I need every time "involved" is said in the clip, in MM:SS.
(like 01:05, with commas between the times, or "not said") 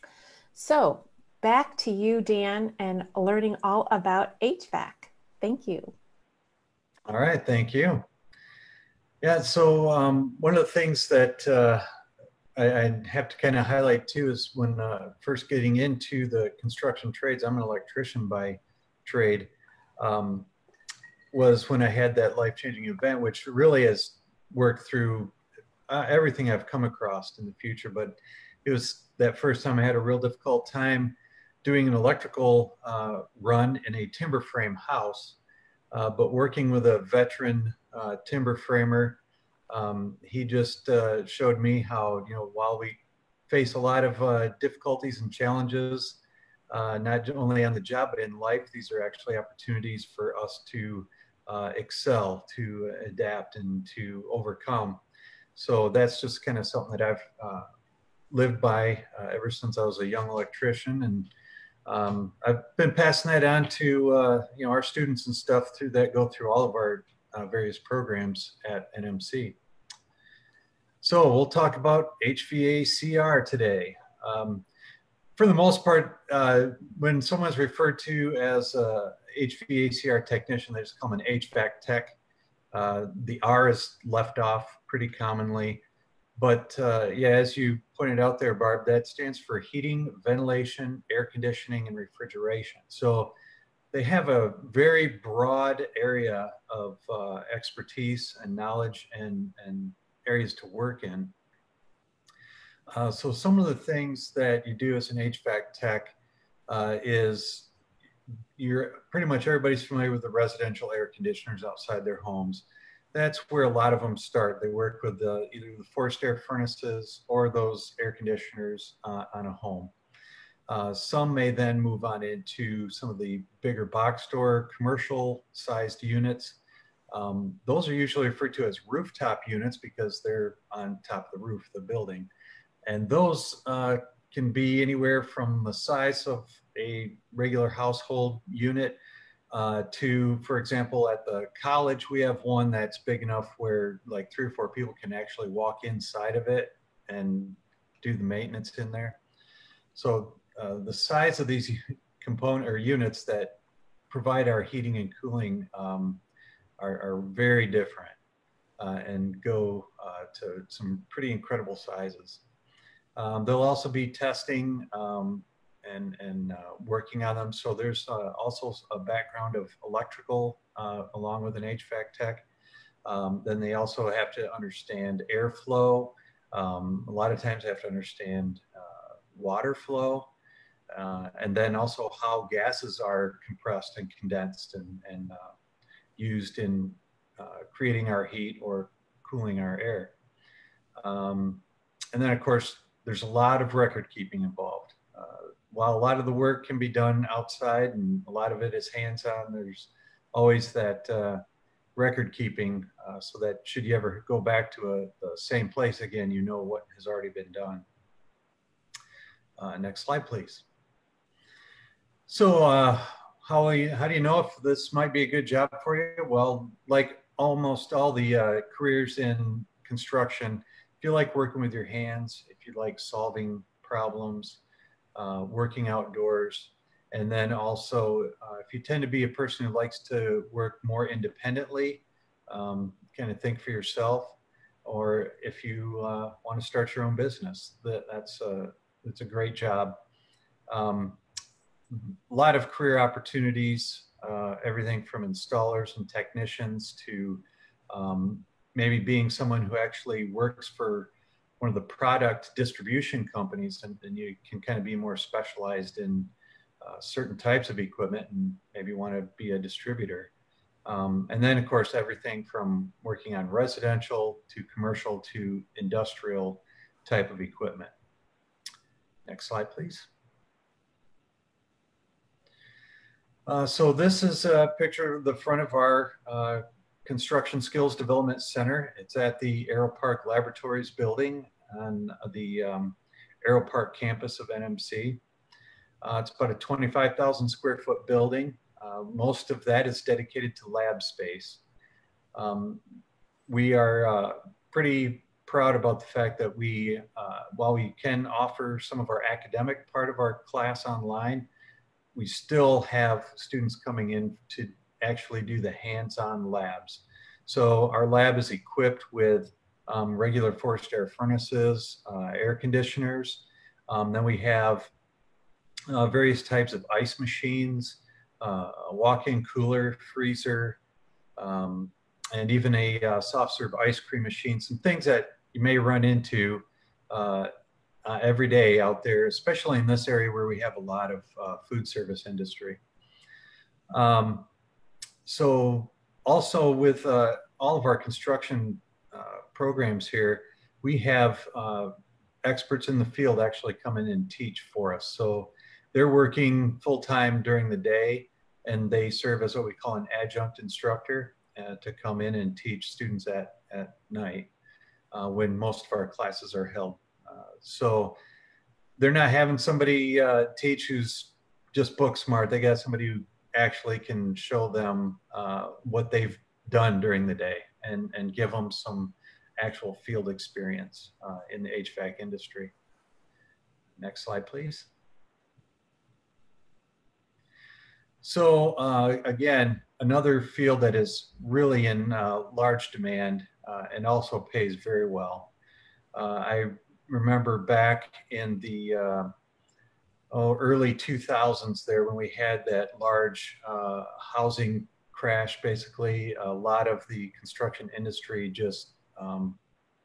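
03:14.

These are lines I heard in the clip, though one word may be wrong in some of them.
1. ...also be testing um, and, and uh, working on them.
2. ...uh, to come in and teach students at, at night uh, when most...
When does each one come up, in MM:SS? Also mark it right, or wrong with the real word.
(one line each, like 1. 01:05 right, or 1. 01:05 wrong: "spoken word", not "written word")
1. 02:43 right
2. 05:51 right.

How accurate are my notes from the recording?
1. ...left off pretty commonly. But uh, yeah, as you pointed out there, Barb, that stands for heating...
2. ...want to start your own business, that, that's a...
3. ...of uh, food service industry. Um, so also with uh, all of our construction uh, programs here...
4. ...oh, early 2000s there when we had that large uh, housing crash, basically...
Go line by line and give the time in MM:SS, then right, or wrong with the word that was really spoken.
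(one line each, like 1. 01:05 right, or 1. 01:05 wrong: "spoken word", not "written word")
1. 01:24 right
2. 03:56 right
3. 05:31 right
4. 06:30 right.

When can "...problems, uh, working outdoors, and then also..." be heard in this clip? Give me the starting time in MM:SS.
03:43.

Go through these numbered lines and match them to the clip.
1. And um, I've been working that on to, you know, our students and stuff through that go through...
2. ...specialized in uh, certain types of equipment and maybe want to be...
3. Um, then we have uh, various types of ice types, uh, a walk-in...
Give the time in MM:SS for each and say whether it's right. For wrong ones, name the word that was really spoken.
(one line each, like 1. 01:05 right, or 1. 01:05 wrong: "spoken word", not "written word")
1. 01:01 wrong: "passing", not "working"
2. 04:15 right
3. 05:13 wrong: "machines", not "types".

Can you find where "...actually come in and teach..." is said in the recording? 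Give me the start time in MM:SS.
05:43.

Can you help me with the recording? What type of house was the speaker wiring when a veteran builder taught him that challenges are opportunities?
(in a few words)
Timber frame house.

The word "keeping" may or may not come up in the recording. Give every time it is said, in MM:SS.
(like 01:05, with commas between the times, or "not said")
03:14, 03:22.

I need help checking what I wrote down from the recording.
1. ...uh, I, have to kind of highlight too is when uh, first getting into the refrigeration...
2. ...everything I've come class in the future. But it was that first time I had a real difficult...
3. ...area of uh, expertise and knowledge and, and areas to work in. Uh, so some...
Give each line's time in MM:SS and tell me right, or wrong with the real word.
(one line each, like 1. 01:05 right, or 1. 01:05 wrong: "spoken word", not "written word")
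1. 00:11 wrong: "construction", not "refrigeration"
2. 00:26 wrong: "across", not "class"
3. 01:36 right.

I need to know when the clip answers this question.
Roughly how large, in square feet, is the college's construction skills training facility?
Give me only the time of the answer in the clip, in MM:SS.
04:46.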